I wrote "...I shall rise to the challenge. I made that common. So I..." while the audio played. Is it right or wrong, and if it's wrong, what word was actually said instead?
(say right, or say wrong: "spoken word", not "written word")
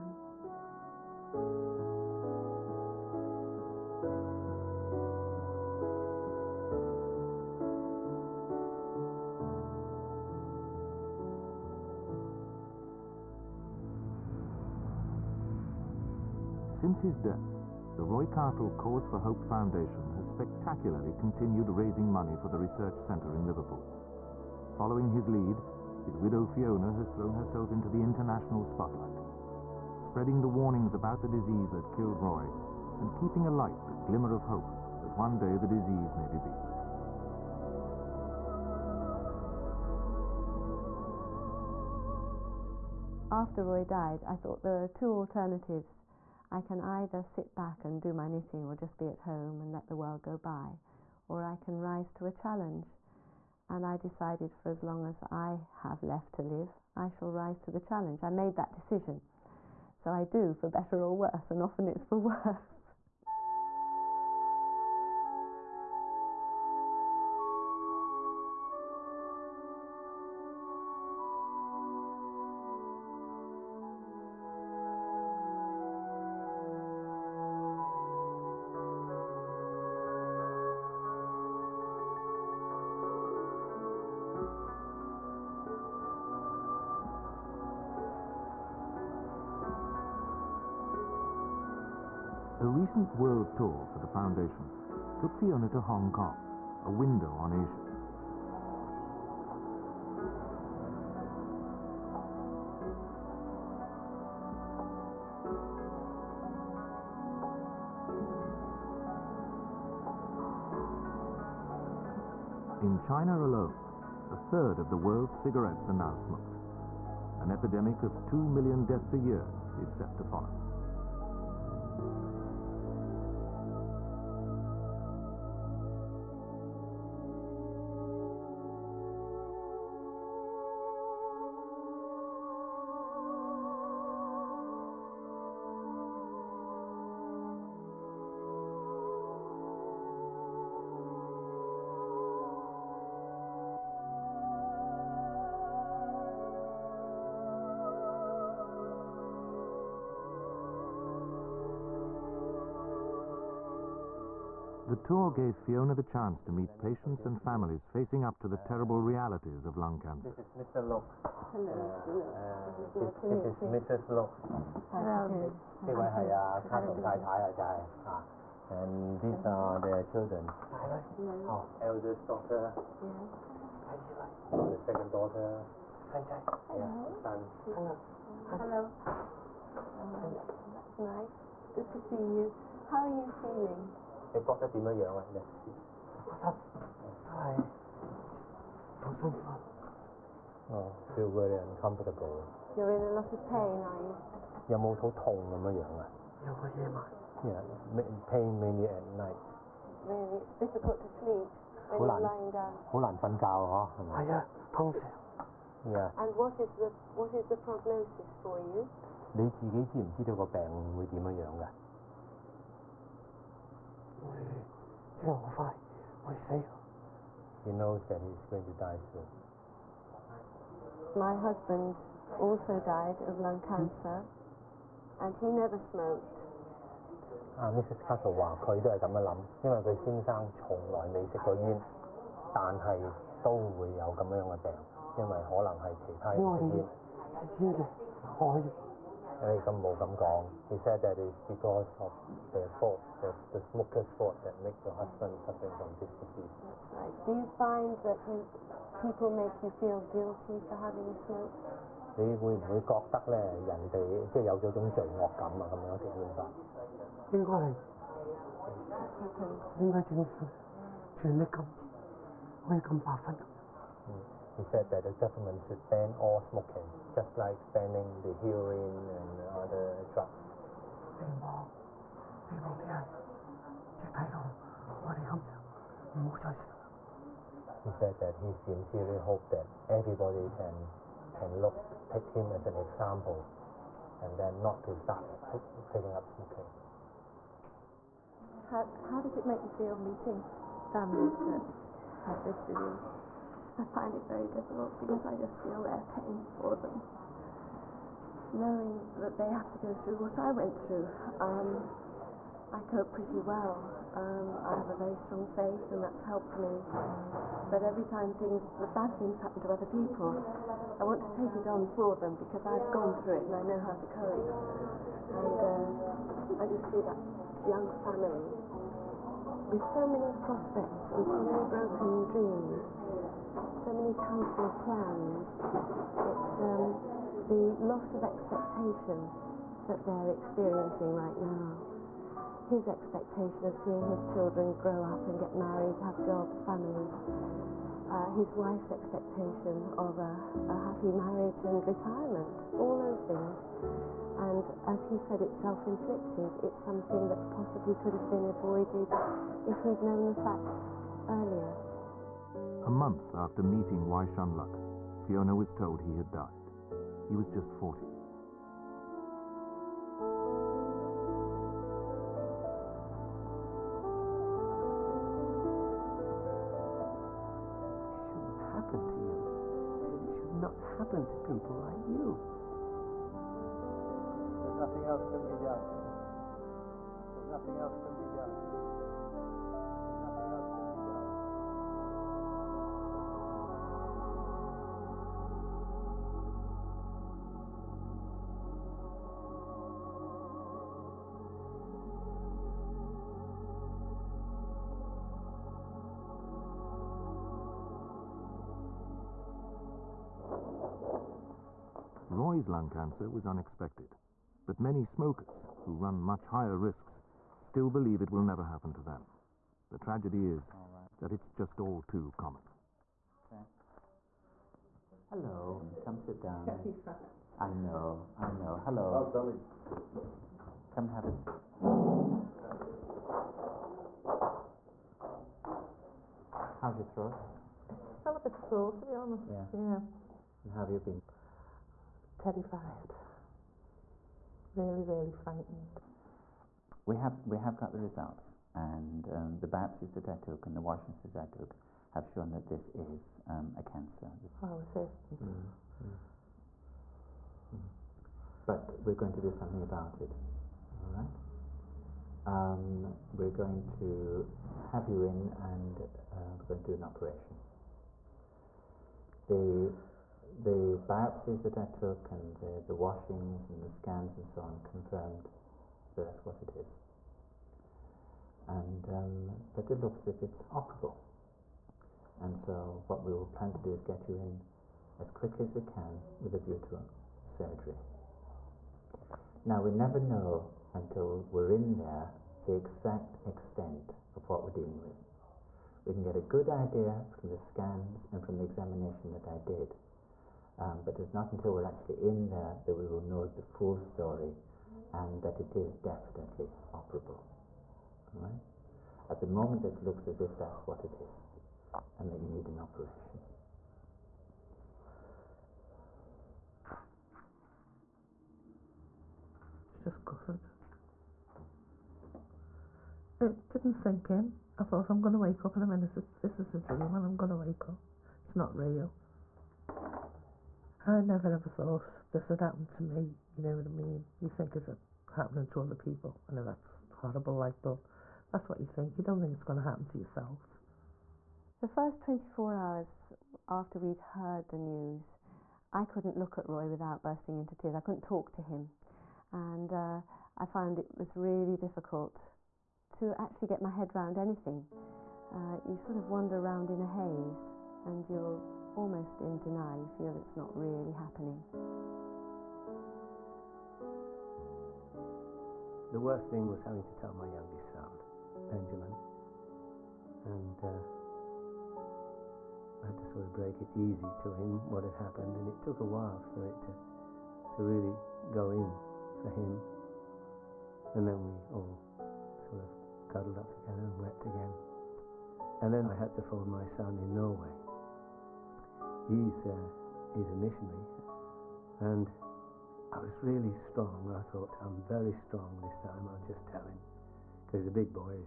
wrong: "decision", not "common".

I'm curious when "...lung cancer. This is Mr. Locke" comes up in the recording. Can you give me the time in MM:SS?
02:39.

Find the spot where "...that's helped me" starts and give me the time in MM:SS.
05:06.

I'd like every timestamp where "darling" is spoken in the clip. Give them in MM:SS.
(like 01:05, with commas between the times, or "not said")
06:59.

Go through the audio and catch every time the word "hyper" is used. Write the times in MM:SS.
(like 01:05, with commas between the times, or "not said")
not said.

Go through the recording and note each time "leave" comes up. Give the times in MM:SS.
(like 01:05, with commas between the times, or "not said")
not said.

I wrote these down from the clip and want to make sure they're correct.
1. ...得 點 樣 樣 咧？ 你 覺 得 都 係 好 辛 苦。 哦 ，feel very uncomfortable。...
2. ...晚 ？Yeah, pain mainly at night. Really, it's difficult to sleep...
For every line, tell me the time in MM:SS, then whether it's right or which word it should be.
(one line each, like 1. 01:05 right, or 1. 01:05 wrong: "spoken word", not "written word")
1. 03:04 right
2. 03:16 right.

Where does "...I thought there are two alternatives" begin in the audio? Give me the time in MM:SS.
00:44.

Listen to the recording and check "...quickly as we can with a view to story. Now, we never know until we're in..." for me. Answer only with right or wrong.
wrong.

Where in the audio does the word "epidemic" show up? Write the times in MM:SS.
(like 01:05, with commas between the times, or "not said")
01:57.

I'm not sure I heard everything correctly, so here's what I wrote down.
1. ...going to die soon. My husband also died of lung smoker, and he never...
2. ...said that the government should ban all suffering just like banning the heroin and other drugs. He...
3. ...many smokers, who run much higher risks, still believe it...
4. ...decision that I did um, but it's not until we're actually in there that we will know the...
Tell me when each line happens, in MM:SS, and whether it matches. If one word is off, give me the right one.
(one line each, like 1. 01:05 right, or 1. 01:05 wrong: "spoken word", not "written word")
1. 03:38 wrong: "cancer", not "smoker"
2. 04:24 wrong: "smoking", not "suffering"
3. 06:44 right
4. 08:08 wrong: "examination", not "decision".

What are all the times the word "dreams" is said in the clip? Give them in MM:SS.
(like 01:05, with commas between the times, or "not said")
05:22, 08:36.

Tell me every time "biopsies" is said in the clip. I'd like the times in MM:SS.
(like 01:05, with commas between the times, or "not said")
07:19, 07:41.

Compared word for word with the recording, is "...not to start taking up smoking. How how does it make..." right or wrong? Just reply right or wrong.
right.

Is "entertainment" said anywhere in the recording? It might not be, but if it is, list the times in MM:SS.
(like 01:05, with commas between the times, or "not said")
not said.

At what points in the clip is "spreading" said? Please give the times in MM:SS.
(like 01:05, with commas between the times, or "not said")
00:29.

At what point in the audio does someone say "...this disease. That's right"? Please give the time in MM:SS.
04:05.